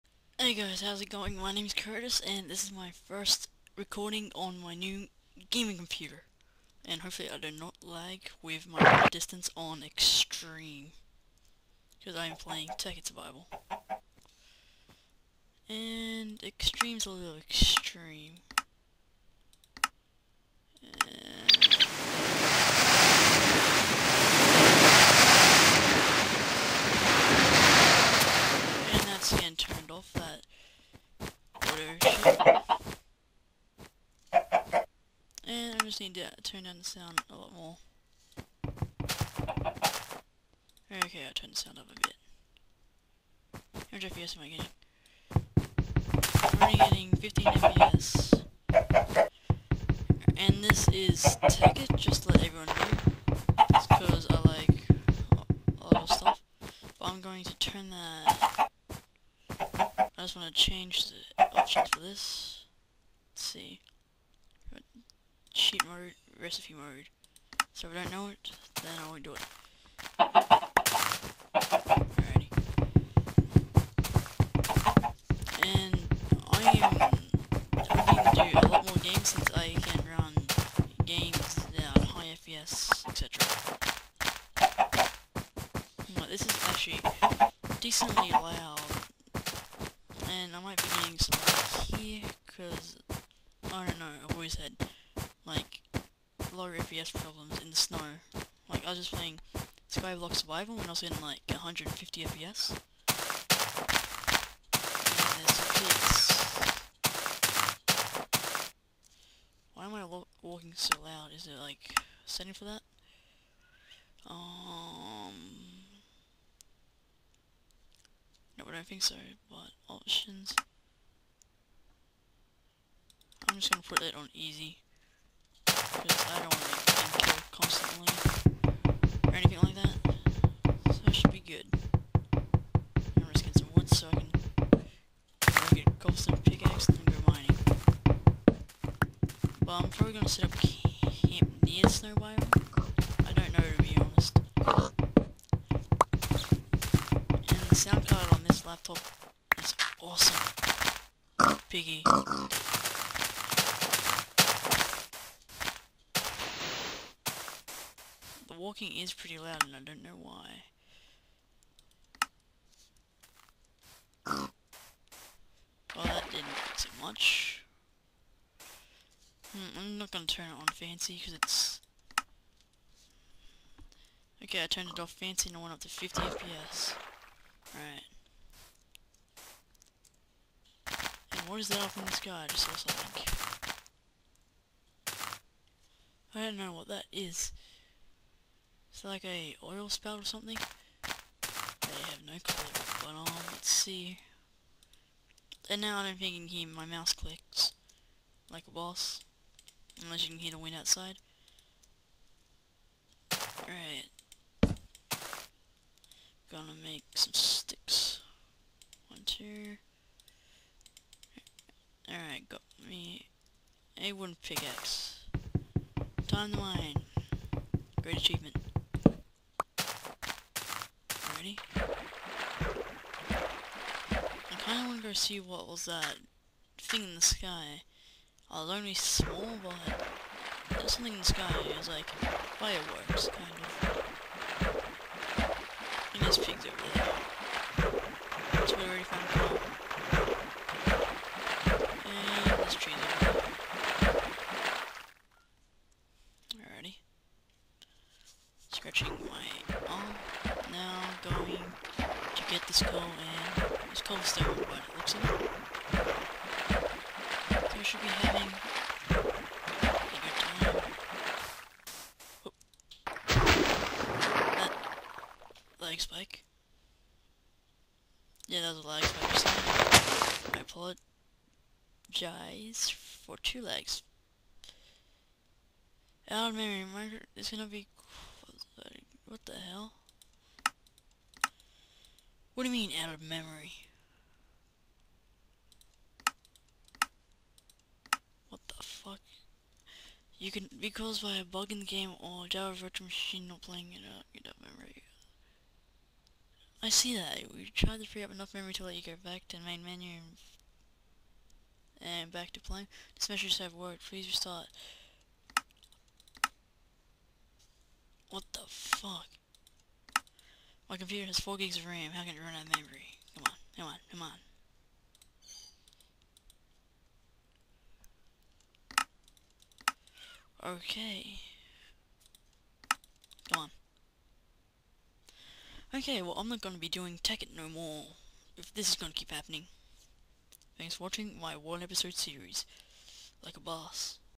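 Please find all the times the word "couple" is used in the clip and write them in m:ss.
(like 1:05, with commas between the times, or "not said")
2:15.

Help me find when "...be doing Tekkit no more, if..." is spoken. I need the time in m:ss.
5:26.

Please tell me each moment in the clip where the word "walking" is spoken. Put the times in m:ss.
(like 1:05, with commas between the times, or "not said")
1:50, 2:38.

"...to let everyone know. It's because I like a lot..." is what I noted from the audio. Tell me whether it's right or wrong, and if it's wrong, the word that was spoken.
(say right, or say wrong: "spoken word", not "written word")
right.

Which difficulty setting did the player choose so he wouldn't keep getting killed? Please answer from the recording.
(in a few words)
easy.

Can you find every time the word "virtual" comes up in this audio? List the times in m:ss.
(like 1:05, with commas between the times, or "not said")
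4:52.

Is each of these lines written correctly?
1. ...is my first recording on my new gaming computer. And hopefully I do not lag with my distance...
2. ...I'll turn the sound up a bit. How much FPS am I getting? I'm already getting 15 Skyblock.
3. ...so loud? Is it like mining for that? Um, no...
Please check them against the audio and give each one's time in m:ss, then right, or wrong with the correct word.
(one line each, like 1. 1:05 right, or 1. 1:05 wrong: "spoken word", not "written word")
1. 0:02 right
2. 0:41 wrong: "FPS", not "Skyblock"
3. 1:50 wrong: "setting", not "mining".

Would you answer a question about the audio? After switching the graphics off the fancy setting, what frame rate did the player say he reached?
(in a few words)
50 FPS.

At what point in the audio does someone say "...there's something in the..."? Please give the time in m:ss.
3:50.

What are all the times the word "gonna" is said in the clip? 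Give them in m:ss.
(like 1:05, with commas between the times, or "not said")
2:03, 2:20, 3:26, 4:37.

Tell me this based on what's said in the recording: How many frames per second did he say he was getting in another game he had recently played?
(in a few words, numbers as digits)
150.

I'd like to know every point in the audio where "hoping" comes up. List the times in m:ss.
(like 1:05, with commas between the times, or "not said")
1:17.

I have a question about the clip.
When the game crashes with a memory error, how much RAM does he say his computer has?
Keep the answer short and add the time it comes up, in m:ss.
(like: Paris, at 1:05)
4 gigs, at 5:11.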